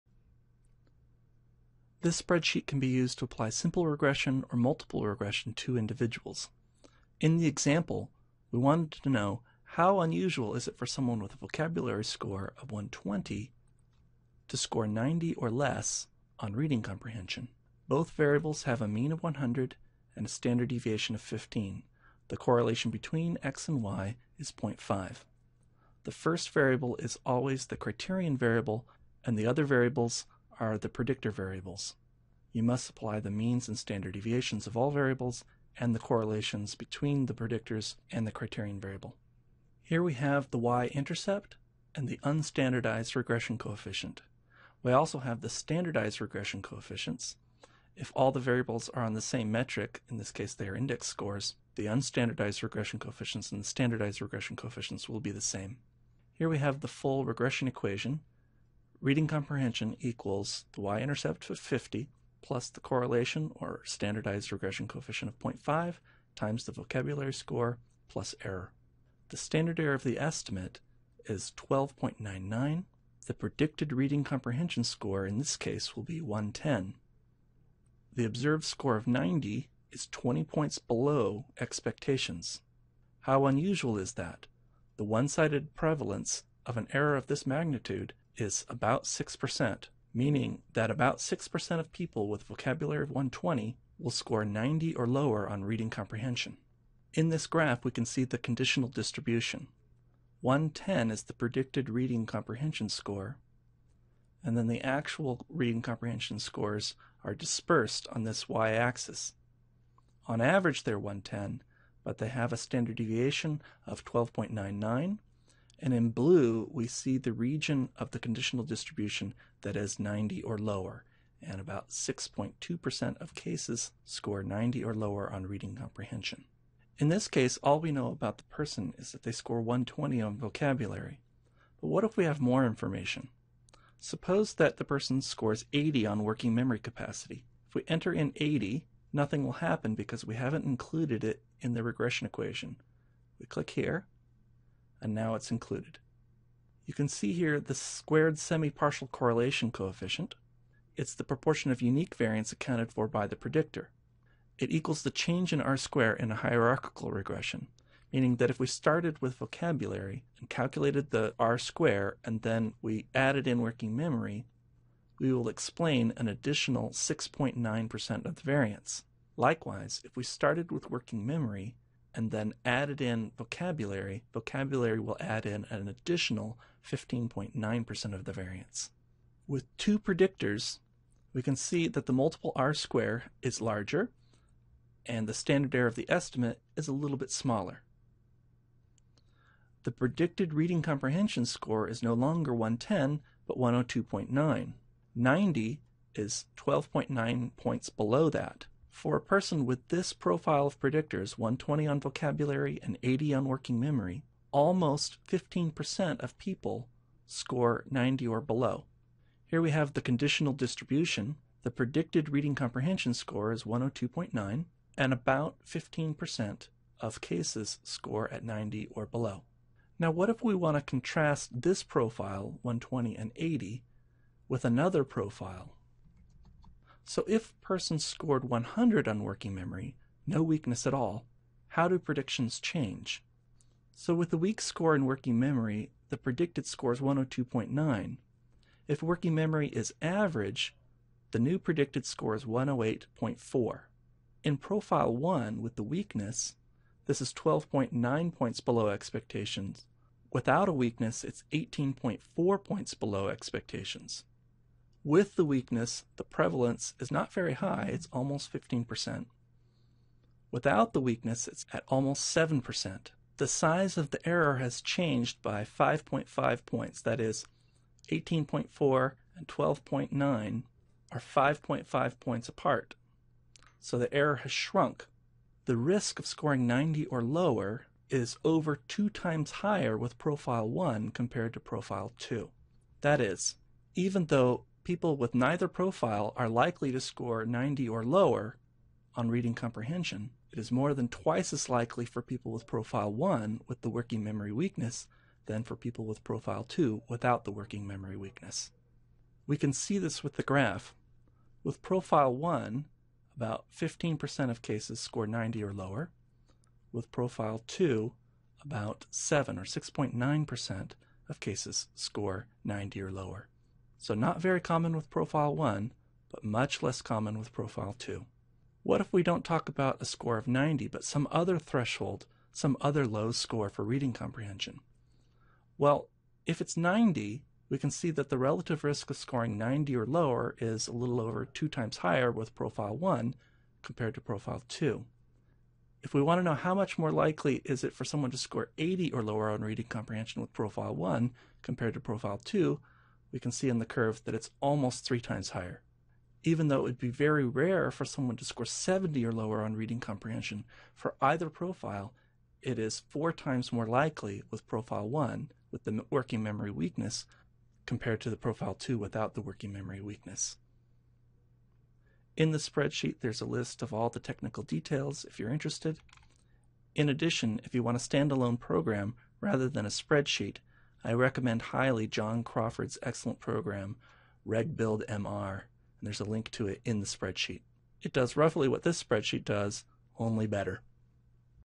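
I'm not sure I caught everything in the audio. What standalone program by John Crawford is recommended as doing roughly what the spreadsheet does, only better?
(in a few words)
Regbuild MR.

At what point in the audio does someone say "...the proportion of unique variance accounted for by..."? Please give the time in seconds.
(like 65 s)
151 s.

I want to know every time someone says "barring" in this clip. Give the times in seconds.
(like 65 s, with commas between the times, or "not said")
not said.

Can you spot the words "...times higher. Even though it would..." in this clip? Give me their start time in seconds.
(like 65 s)
345 s.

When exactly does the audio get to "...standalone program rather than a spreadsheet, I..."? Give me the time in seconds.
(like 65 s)
367 s.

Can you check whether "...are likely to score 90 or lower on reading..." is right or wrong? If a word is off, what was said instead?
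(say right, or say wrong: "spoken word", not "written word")
right.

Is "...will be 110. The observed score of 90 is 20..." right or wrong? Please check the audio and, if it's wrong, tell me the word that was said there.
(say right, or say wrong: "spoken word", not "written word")
right.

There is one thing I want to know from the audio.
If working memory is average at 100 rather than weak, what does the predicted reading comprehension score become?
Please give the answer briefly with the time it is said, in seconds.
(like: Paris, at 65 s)
108.4, at 242 s.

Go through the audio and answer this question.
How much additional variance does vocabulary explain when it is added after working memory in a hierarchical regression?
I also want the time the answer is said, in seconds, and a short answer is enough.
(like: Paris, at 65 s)
15.9%, at 176 s.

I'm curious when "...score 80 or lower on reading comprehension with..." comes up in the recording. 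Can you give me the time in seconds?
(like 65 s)
338 s.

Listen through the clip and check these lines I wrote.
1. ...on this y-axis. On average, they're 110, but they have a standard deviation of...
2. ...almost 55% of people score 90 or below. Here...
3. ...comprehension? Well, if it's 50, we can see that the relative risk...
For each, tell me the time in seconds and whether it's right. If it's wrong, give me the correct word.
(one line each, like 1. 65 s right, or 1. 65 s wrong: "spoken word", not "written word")
1. 108 s right
2. 204 s wrong: "15", not "55"
3. 324 s wrong: "90", not "50".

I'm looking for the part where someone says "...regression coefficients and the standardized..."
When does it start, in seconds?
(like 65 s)
52 s.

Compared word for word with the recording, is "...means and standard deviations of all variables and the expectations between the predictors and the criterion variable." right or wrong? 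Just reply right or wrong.
wrong.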